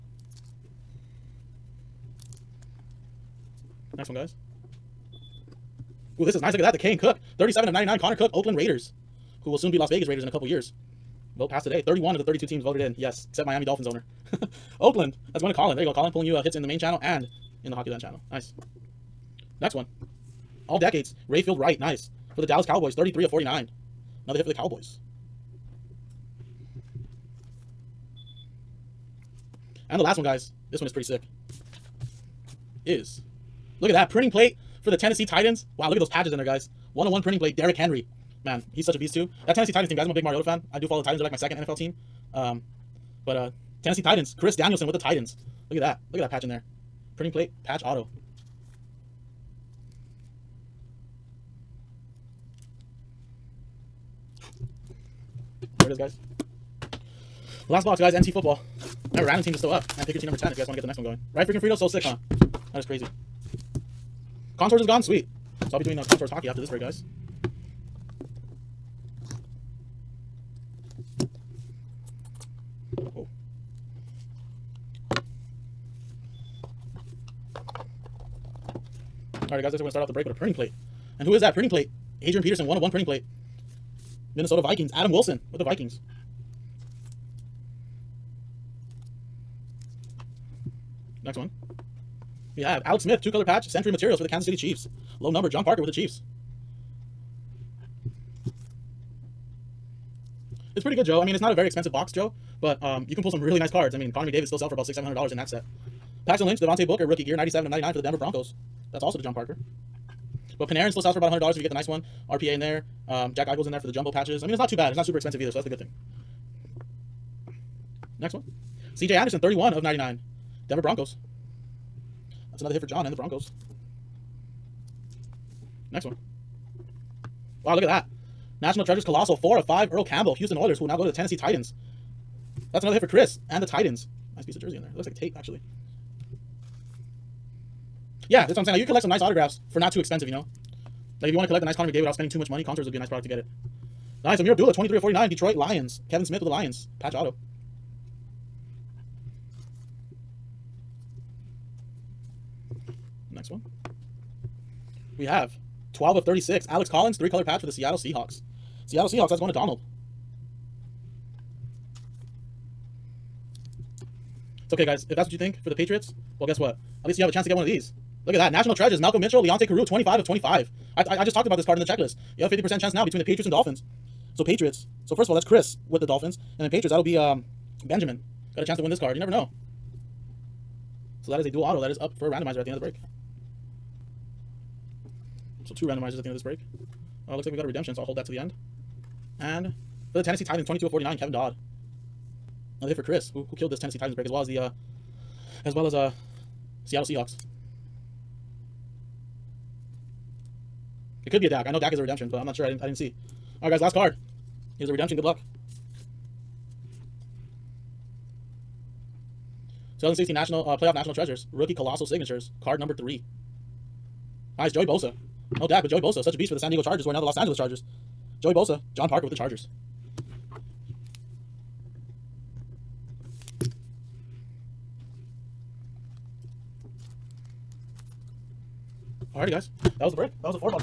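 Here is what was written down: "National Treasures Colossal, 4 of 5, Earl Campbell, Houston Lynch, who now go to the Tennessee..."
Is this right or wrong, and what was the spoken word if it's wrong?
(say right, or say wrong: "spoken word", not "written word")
wrong: "Oilers", not "Lynch".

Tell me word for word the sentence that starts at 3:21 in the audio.
I know Dak is a redemption, but I'm not sure.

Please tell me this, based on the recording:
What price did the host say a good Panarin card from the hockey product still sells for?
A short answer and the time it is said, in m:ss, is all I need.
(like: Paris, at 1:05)
$100, at 1:51.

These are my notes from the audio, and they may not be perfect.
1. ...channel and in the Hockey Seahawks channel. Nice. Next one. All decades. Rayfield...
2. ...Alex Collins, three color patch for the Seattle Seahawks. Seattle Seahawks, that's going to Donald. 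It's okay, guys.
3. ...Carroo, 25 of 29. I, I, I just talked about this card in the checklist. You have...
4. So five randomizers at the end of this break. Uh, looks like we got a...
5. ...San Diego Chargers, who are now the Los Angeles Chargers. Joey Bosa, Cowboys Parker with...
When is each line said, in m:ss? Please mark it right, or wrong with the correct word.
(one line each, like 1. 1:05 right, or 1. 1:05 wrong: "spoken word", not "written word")
1. 0:16 wrong: "Land", not "Seahawks"
2. 2:36 right
3. 2:49 wrong: "25", not "29"
4. 3:05 wrong: "two", not "five"
5. 3:36 wrong: "John", not "Cowboys".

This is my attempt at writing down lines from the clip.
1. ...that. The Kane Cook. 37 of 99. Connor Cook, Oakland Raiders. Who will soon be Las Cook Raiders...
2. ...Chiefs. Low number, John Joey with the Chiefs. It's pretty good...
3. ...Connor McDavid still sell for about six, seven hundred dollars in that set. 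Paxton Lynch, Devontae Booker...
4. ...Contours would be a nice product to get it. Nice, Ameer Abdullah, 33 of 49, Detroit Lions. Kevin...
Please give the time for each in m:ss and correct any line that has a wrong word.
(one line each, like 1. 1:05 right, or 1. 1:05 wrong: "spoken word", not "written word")
1. 0:06 wrong: "Vegas", not "Cook"
2. 1:34 wrong: "Parker", not "Joey"
3. 1:44 right
4. 2:22 wrong: "23", not "33".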